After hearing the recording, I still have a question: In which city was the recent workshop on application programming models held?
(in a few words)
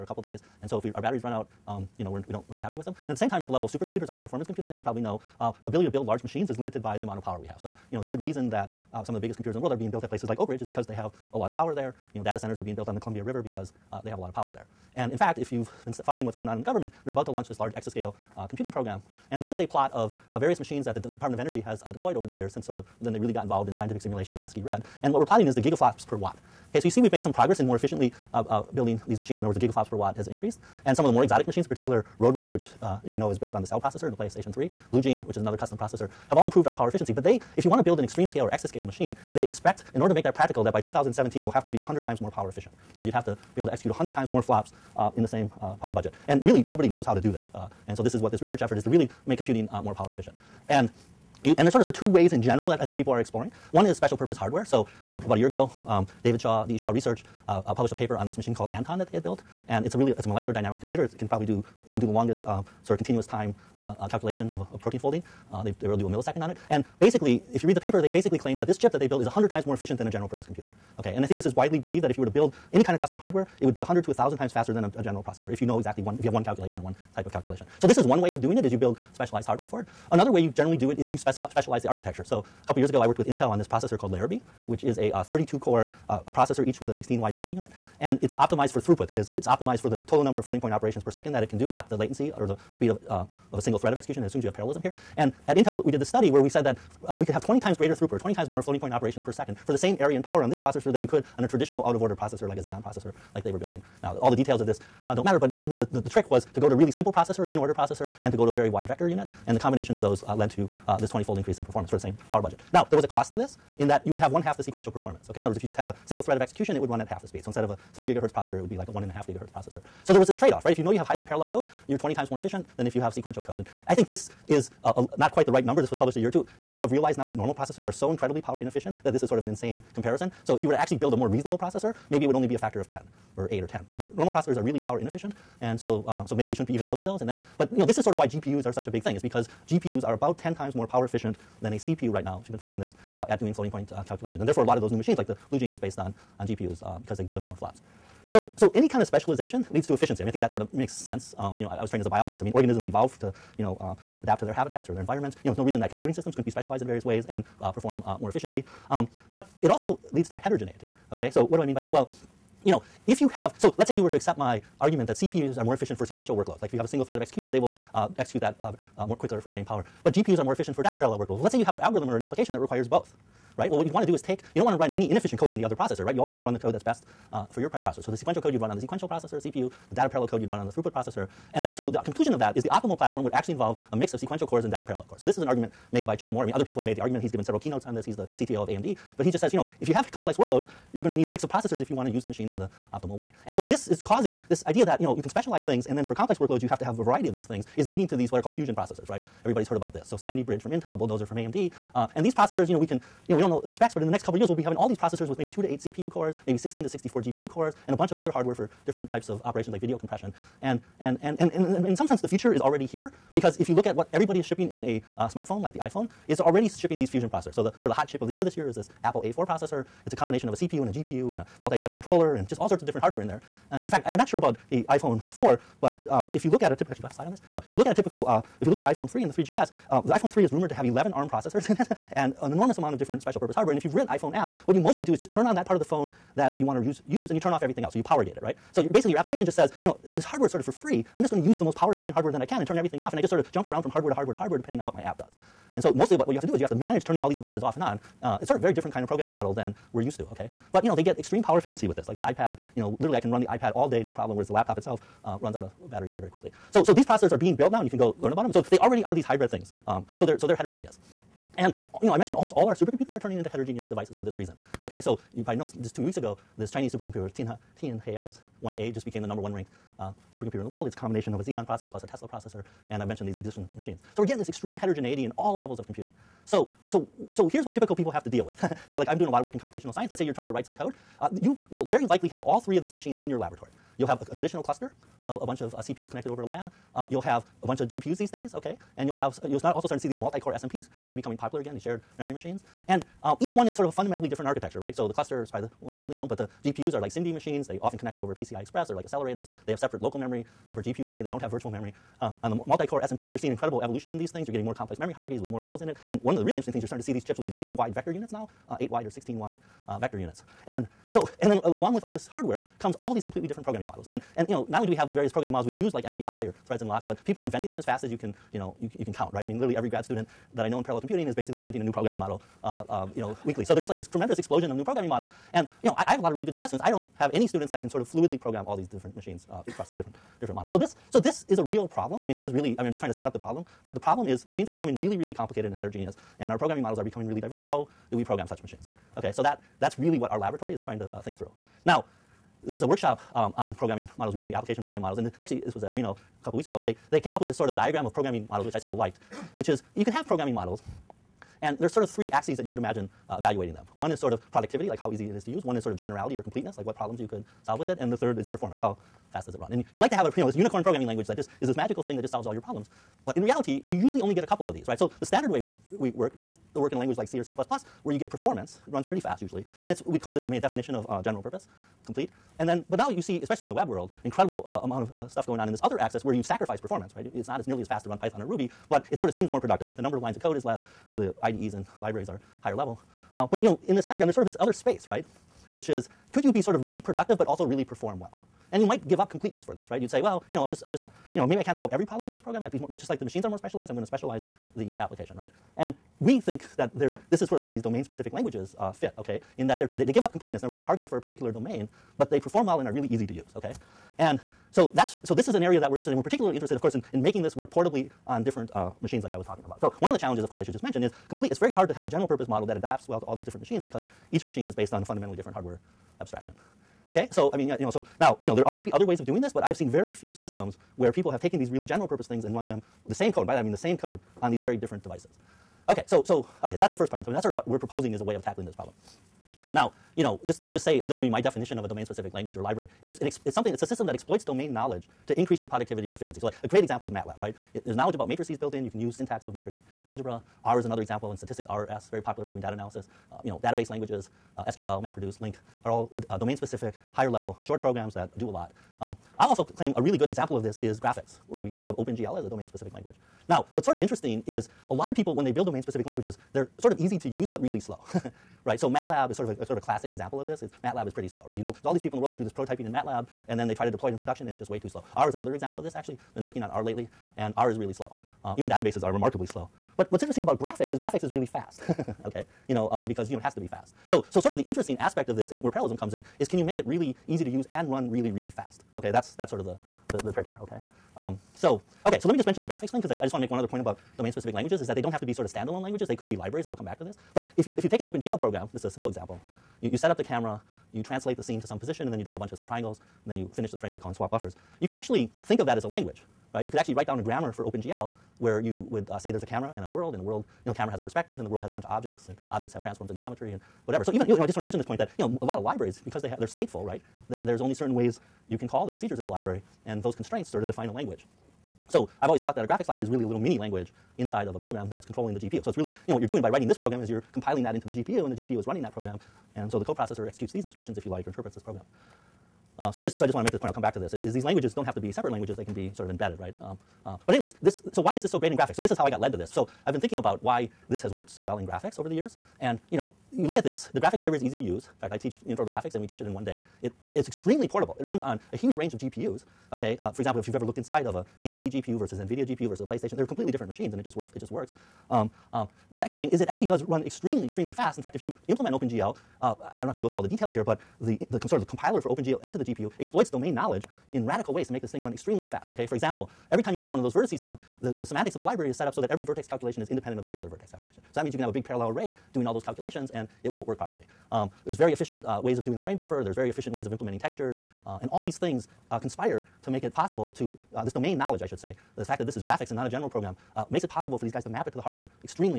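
Reno.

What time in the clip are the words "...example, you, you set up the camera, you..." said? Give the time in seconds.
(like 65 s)
489 s.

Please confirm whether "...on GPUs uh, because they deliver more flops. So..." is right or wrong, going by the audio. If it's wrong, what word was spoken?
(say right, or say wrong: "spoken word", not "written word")
right.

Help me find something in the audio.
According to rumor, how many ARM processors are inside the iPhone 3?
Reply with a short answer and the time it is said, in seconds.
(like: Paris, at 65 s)
11, at 230 s.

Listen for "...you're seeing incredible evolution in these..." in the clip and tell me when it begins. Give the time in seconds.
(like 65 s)
303 s.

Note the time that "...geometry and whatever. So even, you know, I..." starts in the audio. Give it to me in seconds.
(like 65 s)
503 s.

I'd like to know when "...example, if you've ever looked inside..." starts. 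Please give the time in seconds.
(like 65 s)
540 s.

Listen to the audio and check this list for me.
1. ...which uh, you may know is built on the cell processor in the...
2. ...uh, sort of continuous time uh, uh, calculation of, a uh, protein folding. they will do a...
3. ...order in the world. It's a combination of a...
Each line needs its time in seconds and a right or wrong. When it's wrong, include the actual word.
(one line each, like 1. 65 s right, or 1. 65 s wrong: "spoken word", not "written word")
1. 32 s right
2. 62 s right
3. 270 s wrong: "supercomputer", not "order".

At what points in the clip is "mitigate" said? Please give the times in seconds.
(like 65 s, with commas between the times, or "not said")
not said.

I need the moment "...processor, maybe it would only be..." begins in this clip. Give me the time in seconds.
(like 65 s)
131 s.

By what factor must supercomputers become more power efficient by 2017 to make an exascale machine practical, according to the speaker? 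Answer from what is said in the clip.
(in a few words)
100 times.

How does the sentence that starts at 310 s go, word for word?
And so, and then along with all this hardware, comes all these completely different programming models.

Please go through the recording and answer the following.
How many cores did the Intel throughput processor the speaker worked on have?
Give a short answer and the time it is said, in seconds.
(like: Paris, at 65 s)
32, at 85 s.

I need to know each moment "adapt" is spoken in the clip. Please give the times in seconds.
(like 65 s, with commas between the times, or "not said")
154 s, 412 s.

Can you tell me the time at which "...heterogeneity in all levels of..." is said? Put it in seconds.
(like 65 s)
274 s.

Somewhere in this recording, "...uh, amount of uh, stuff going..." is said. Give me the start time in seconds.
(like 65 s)
374 s.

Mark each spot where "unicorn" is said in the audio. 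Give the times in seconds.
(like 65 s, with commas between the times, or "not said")
360 s.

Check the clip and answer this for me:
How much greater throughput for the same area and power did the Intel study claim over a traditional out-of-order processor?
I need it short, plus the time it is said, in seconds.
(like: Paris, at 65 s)
20 times, at 97 s.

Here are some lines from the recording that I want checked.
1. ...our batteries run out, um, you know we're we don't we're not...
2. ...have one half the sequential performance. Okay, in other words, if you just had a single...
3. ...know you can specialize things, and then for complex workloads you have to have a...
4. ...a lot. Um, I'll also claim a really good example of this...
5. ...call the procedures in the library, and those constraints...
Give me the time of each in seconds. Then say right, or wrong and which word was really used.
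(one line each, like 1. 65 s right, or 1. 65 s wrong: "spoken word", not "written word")
1. 0 s right
2. 114 s right
3. 195 s right
4. 448 s right
5. 508 s right.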